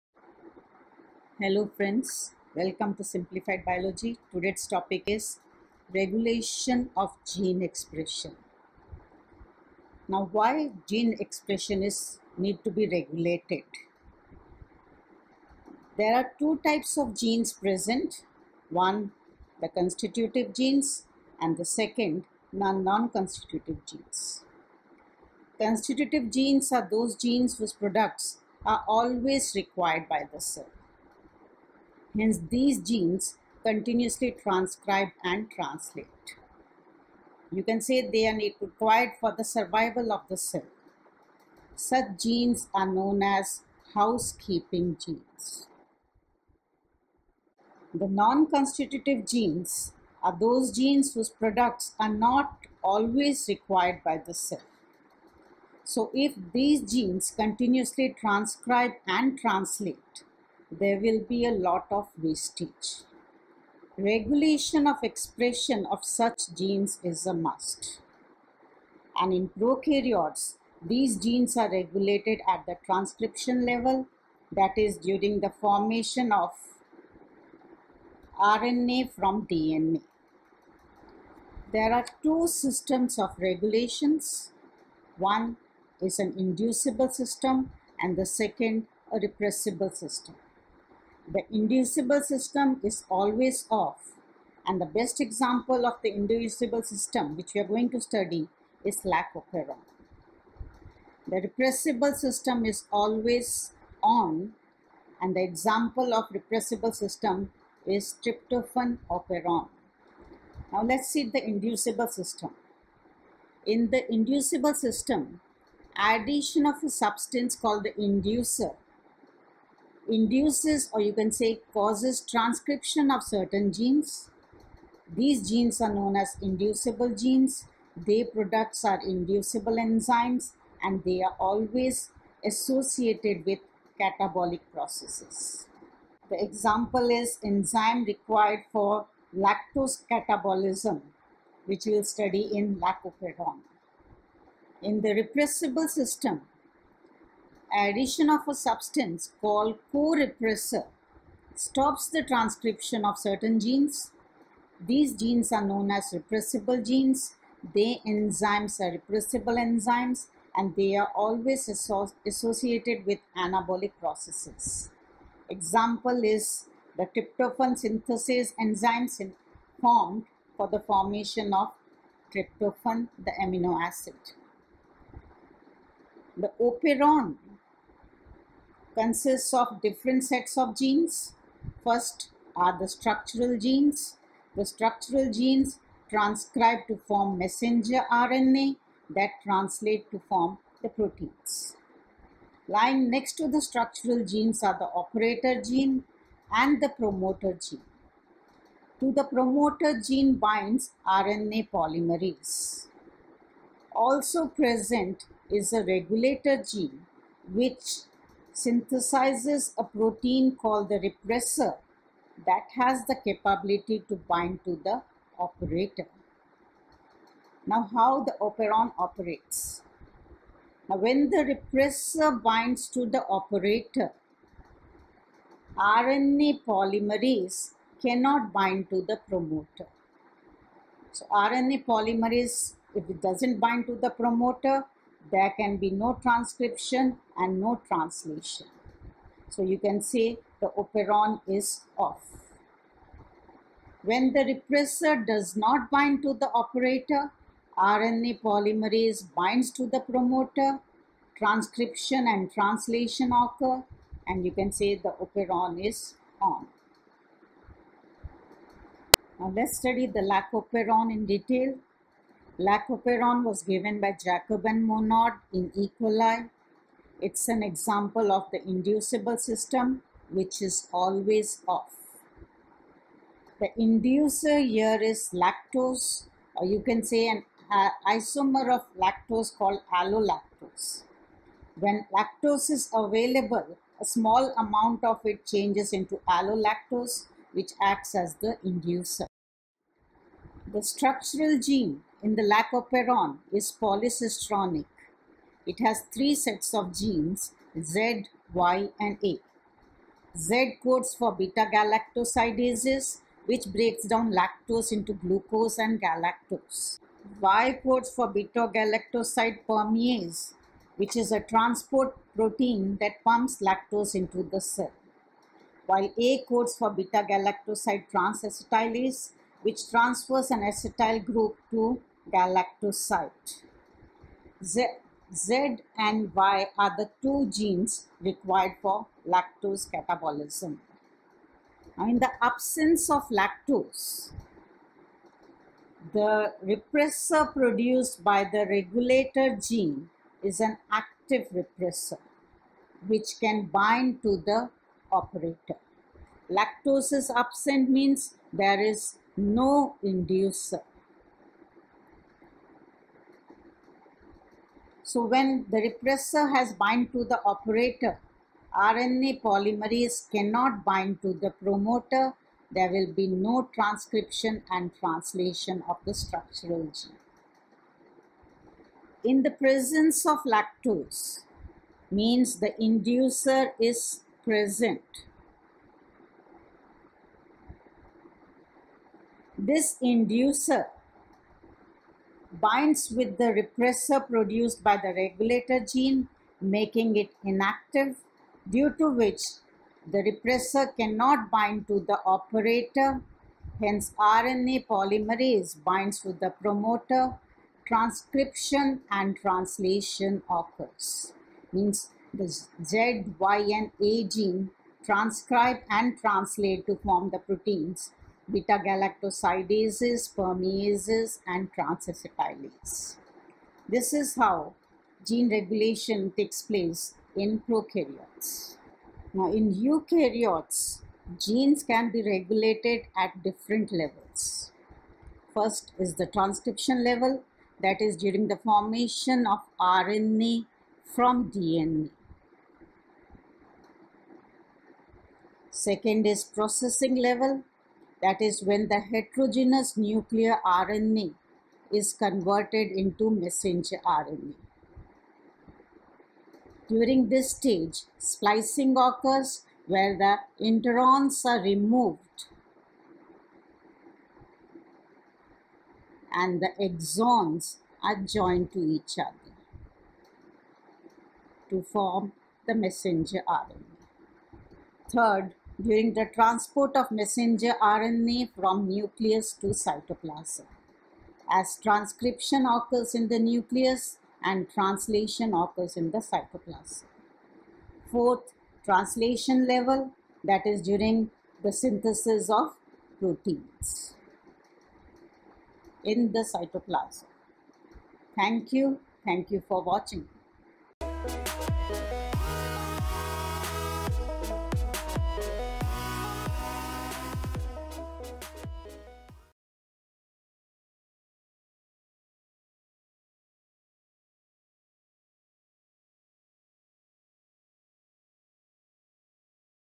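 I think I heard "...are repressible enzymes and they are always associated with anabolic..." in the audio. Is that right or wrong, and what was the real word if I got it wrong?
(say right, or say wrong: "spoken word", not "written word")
right.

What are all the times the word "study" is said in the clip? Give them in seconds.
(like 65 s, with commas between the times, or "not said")
98 s, 142 s, 259 s.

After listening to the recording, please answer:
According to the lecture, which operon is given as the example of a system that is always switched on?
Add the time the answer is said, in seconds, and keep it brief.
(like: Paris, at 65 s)
Tryptophan operon, at 108 s.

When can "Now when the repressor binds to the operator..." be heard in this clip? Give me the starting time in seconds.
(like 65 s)
220 s.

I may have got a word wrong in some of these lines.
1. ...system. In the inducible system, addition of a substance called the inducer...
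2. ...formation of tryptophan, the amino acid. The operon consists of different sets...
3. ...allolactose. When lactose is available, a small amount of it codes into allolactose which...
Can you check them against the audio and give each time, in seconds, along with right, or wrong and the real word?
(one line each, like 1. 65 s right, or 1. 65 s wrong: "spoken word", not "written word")
1. 112 s right
2. 170 s right
3. 279 s wrong: "changes", not "codes".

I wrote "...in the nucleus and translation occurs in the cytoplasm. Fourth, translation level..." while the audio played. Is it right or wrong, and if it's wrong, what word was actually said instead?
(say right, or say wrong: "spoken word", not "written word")
right.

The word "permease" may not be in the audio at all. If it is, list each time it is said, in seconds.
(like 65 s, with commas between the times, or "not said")
309 s, 410 s.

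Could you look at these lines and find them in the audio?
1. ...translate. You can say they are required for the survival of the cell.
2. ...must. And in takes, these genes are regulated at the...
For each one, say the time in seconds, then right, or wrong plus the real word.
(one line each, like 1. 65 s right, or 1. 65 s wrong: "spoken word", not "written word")
1. 35 s right
2. 67 s wrong: "prokaryotes", not "takes".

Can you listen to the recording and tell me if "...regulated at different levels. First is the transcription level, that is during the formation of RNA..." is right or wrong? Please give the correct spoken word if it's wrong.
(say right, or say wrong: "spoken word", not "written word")
right.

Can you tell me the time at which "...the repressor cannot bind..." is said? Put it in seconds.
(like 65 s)
390 s.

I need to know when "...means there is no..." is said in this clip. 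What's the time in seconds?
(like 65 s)
347 s.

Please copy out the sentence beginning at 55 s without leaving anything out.
So if these genes continuously transcribe and translate, there will be a lot of wastage.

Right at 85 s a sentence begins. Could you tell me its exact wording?
One is an inducible system and the second a repressible system.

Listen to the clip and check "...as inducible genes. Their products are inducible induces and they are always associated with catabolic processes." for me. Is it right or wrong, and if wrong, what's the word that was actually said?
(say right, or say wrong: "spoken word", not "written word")
wrong: "enzymes", not "induces".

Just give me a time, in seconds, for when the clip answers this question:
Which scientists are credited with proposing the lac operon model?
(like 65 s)
264 s.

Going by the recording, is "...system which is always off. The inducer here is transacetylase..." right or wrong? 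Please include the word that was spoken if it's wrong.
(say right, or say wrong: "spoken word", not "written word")
wrong: "lactose", not "transacetylase".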